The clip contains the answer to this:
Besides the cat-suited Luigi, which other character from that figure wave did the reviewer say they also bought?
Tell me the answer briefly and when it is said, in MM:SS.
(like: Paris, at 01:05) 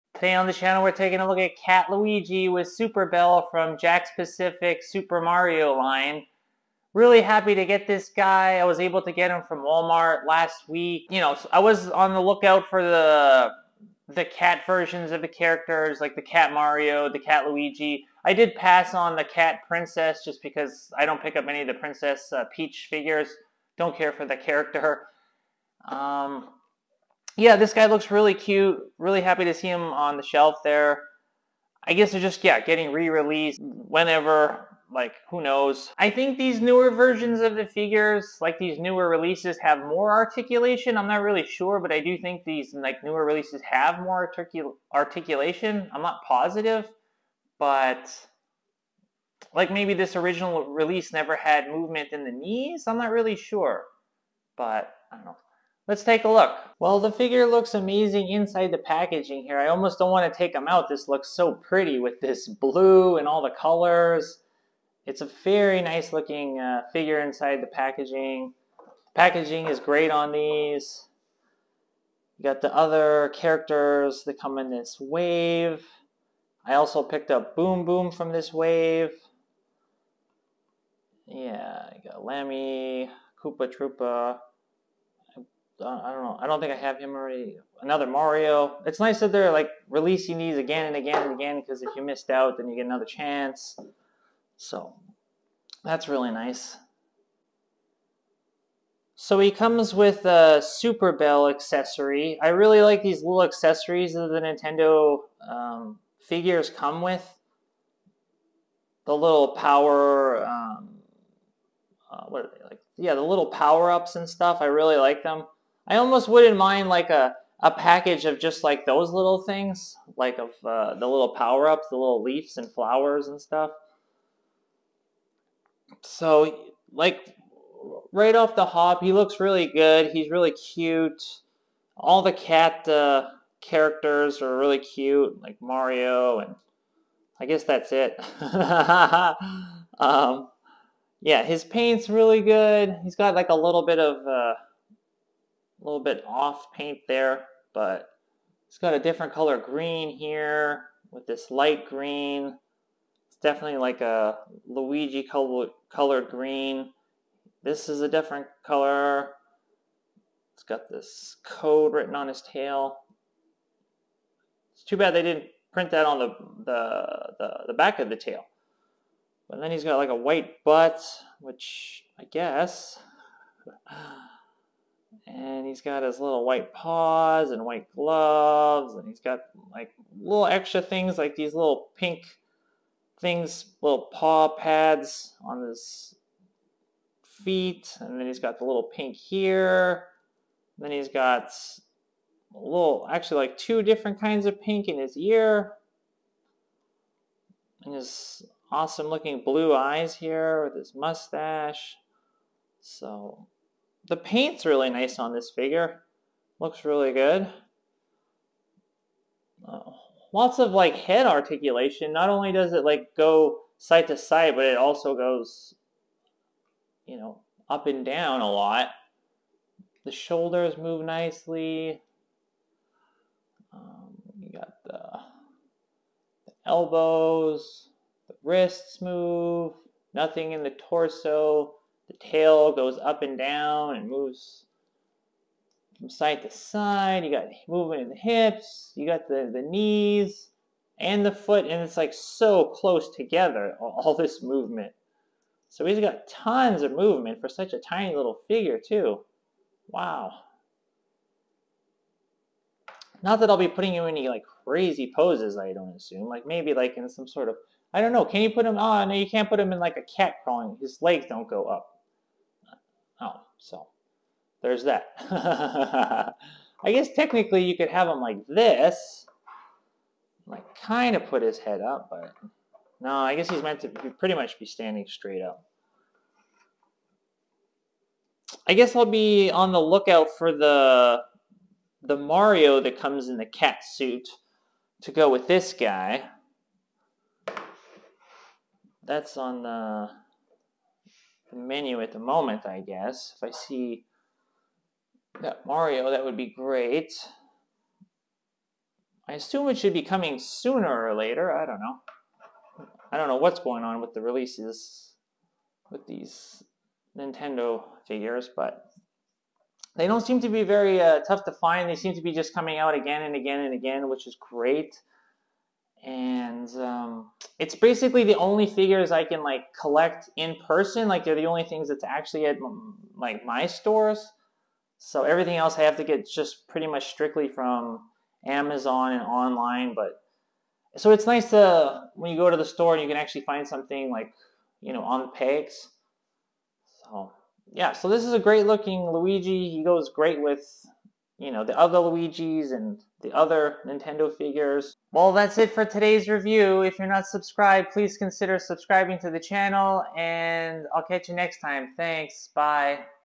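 Boom Boom, at 01:17.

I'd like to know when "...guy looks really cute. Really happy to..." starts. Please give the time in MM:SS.
00:27.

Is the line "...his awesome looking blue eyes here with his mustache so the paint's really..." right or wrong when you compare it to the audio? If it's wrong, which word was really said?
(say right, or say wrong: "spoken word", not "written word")
right.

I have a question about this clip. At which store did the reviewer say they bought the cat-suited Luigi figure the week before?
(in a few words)
Walmart.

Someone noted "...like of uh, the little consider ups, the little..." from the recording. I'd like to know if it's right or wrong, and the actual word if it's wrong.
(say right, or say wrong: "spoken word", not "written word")
wrong: "power", not "consider".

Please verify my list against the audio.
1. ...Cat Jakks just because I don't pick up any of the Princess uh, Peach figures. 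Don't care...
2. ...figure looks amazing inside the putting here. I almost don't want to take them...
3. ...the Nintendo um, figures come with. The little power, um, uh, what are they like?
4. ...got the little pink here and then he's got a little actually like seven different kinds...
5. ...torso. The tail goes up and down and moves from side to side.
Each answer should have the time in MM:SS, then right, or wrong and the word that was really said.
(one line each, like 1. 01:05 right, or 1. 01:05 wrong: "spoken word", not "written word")
1. 00:19 wrong: "Princess", not "Jakks"
2. 00:57 wrong: "packaging", not "putting"
3. 01:44 right
4. 03:08 wrong: "two", not "seven"
5. 03:50 right.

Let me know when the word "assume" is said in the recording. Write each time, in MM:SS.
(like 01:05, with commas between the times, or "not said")
04:15, 04:59.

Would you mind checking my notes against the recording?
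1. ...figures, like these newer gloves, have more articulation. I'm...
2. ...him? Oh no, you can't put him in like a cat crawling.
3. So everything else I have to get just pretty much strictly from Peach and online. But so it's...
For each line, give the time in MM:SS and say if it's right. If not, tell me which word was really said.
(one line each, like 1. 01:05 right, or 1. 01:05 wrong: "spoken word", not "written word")
1. 00:37 wrong: "releases", not "gloves"
2. 04:18 right
3. 05:24 wrong: "Amazon", not "Peach".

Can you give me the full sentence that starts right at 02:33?
It's definitely like a Luigi colored green.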